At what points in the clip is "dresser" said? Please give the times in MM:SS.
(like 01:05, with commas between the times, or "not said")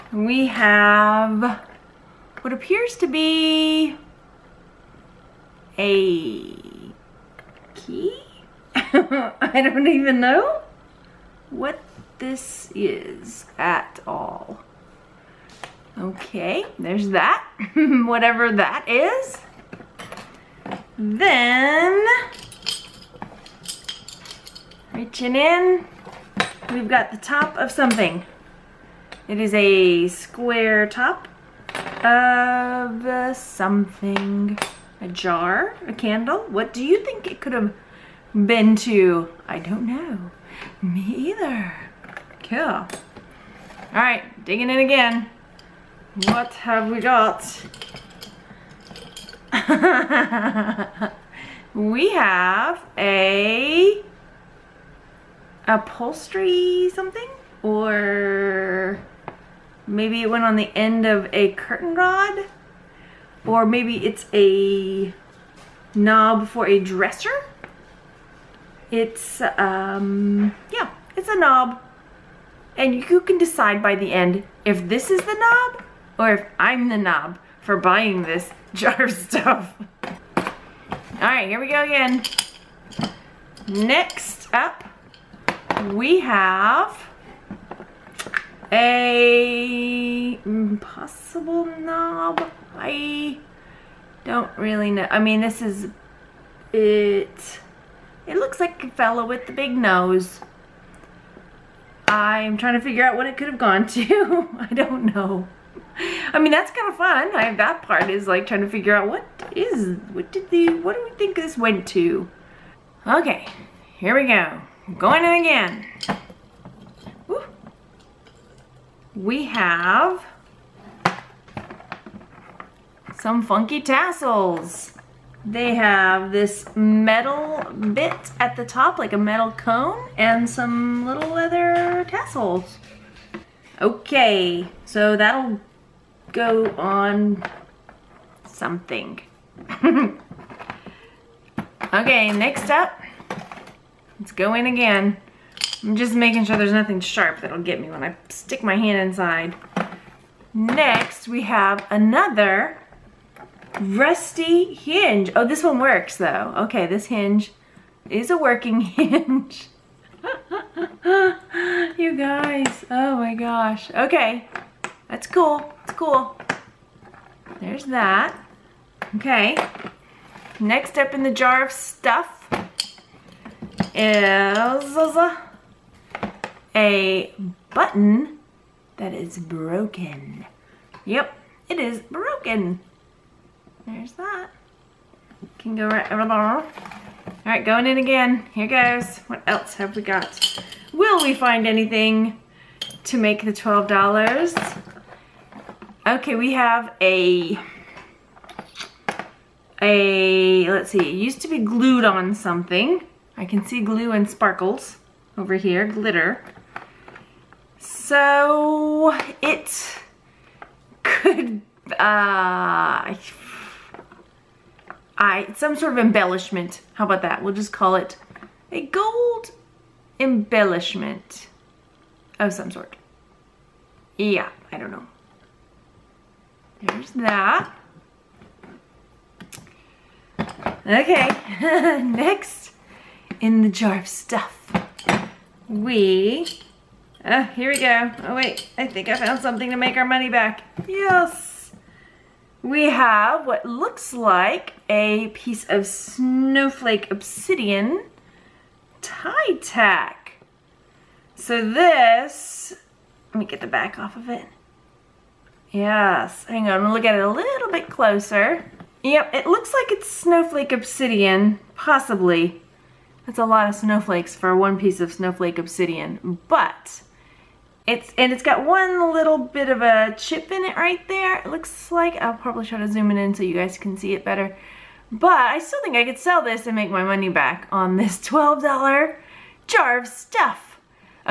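01:06.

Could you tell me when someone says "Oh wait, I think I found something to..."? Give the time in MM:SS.
03:58.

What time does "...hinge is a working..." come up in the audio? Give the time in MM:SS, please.
02:37.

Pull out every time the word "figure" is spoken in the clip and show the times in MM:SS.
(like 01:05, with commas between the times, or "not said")
01:42, 01:48.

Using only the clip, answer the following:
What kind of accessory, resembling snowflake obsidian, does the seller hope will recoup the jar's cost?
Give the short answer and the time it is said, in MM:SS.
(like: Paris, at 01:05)
tie tack, at 04:08.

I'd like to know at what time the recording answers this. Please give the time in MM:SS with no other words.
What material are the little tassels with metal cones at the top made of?
02:11.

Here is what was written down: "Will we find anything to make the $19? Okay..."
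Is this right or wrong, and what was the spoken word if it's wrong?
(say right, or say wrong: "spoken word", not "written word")
wrong: "12", not "19".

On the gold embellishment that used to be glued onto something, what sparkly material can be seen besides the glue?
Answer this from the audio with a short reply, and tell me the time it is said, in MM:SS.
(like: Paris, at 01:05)
glitter, at 03:25.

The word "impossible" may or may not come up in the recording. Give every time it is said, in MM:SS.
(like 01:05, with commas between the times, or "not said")
01:30.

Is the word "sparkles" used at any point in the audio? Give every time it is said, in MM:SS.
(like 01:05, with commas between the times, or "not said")
03:24.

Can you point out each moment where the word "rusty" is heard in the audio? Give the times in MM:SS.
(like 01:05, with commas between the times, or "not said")
02:33.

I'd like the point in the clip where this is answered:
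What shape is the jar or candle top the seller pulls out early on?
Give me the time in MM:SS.
00:30.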